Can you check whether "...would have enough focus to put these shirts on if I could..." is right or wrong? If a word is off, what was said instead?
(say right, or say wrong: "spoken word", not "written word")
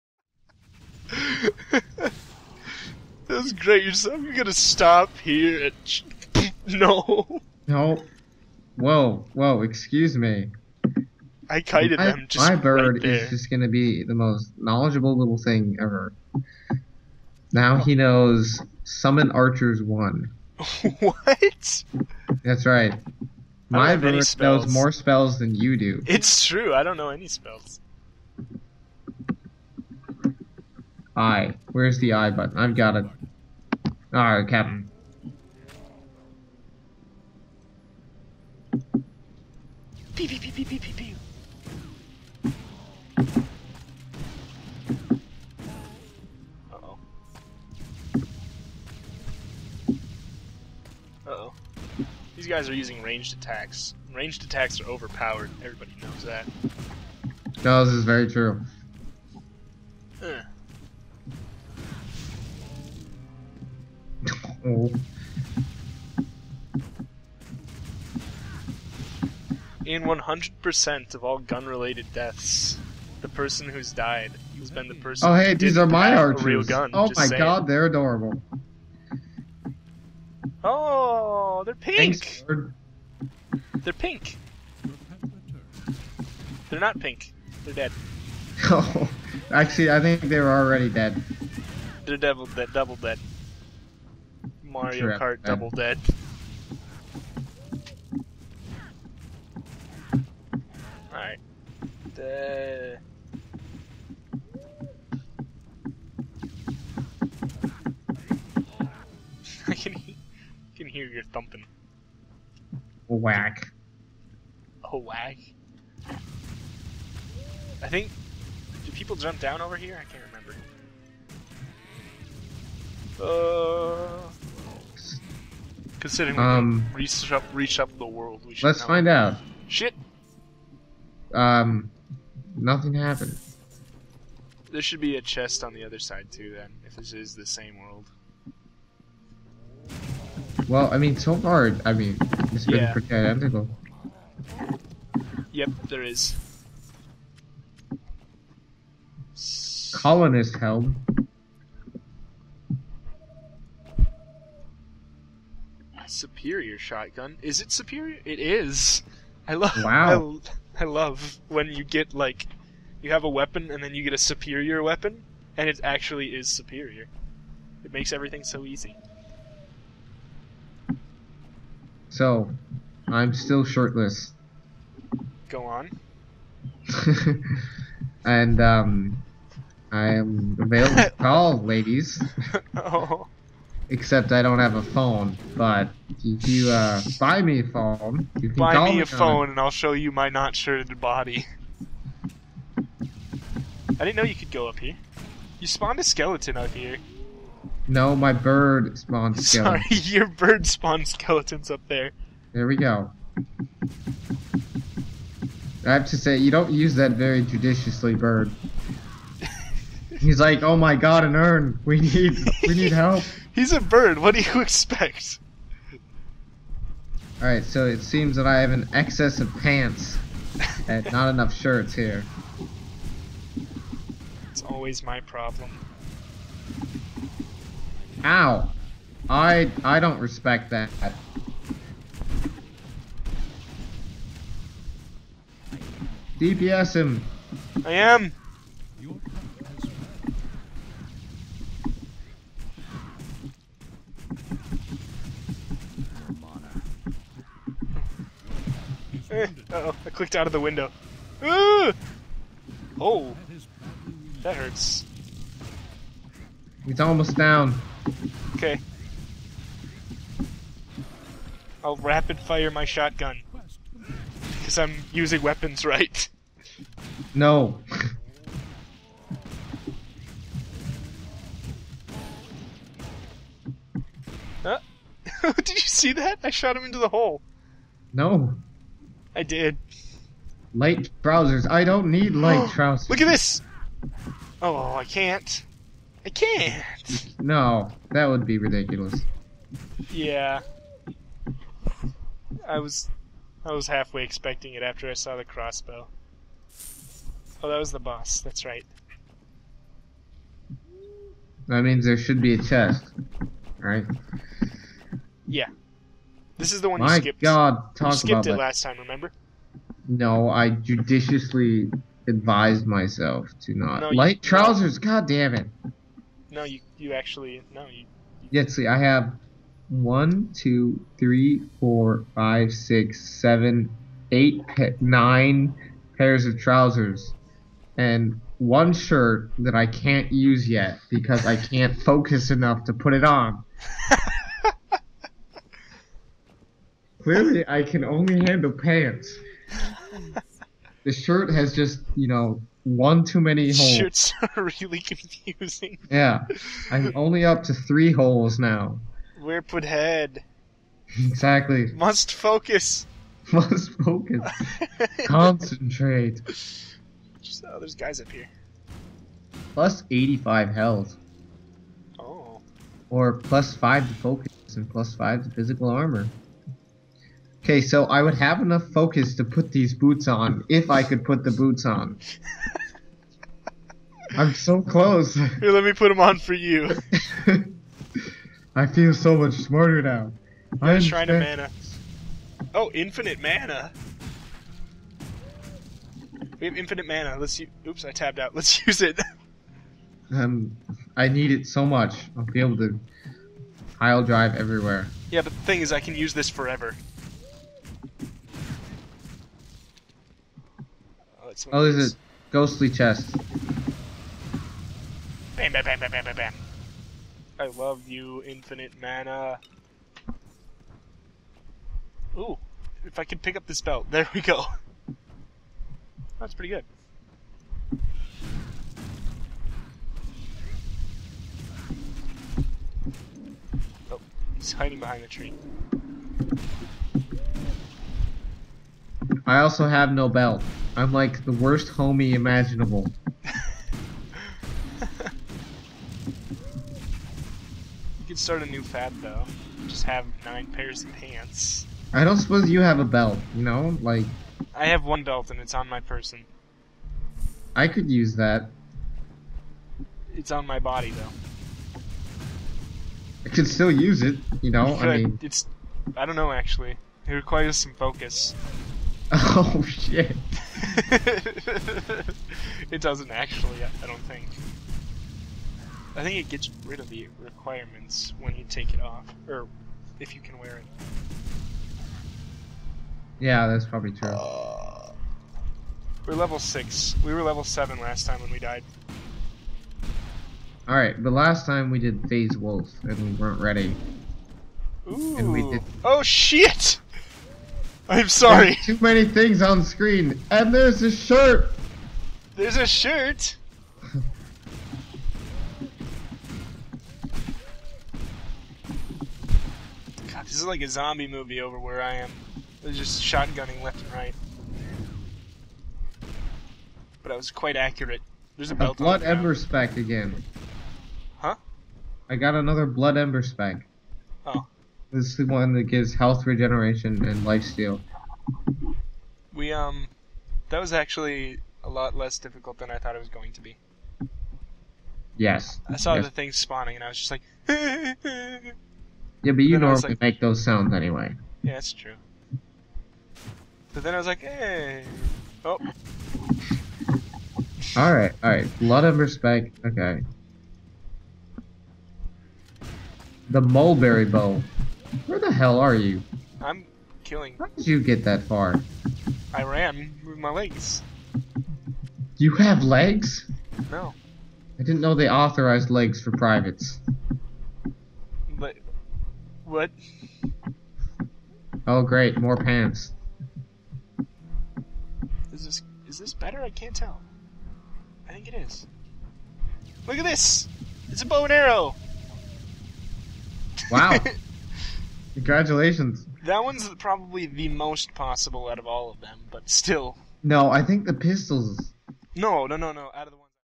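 wrong: "boots", not "shirts".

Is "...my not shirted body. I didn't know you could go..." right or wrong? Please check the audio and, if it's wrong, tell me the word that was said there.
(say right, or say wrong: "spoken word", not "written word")
right.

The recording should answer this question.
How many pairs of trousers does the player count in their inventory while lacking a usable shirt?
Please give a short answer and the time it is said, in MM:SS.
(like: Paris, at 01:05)
9, at 05:25.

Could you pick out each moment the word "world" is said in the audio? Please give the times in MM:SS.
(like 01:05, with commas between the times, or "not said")
02:08, 02:17.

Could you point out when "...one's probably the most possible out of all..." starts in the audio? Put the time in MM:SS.
09:36.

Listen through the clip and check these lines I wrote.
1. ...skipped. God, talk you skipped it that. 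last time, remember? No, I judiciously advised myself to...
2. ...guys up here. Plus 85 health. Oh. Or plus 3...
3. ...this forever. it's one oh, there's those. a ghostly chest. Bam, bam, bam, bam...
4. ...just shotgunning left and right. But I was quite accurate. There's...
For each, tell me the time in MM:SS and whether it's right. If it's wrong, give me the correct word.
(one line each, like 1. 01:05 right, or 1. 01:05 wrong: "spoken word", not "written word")
1. 05:07 right
2. 05:57 wrong: "5", not "3"
3. 06:36 right
4. 08:22 right.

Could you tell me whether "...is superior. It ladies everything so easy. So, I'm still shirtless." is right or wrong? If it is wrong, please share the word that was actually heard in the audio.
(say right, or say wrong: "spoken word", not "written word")
wrong: "makes", not "ladies".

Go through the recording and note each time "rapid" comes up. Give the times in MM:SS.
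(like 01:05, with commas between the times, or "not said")
04:21.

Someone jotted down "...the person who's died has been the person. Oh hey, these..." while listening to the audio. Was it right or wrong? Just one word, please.
right.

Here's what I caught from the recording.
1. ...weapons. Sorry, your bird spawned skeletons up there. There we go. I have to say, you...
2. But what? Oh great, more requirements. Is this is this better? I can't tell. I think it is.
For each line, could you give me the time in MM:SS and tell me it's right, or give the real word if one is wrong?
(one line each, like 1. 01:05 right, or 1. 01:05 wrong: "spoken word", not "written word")
1. 03:19 wrong: "skeletons", not "weapons"
2. 09:18 wrong: "pants", not "requirements".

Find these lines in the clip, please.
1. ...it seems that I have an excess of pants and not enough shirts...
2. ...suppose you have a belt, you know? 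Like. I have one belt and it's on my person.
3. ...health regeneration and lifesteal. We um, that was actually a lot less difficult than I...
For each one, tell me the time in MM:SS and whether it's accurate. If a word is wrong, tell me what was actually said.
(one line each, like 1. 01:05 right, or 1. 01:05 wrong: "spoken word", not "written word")
1. 03:37 right
2. 07:22 right
3. 08:36 right.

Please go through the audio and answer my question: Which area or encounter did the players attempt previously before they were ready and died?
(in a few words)
Phase Wolf.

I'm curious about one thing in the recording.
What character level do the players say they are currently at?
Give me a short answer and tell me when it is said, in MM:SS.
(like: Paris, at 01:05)
6, at 07:56.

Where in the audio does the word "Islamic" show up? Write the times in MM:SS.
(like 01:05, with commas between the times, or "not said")
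not said.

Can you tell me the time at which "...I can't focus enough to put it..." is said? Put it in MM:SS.
05:31.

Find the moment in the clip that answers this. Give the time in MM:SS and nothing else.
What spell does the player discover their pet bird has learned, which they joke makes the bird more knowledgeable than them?
00:18.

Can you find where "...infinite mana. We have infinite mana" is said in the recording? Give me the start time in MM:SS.
06:22.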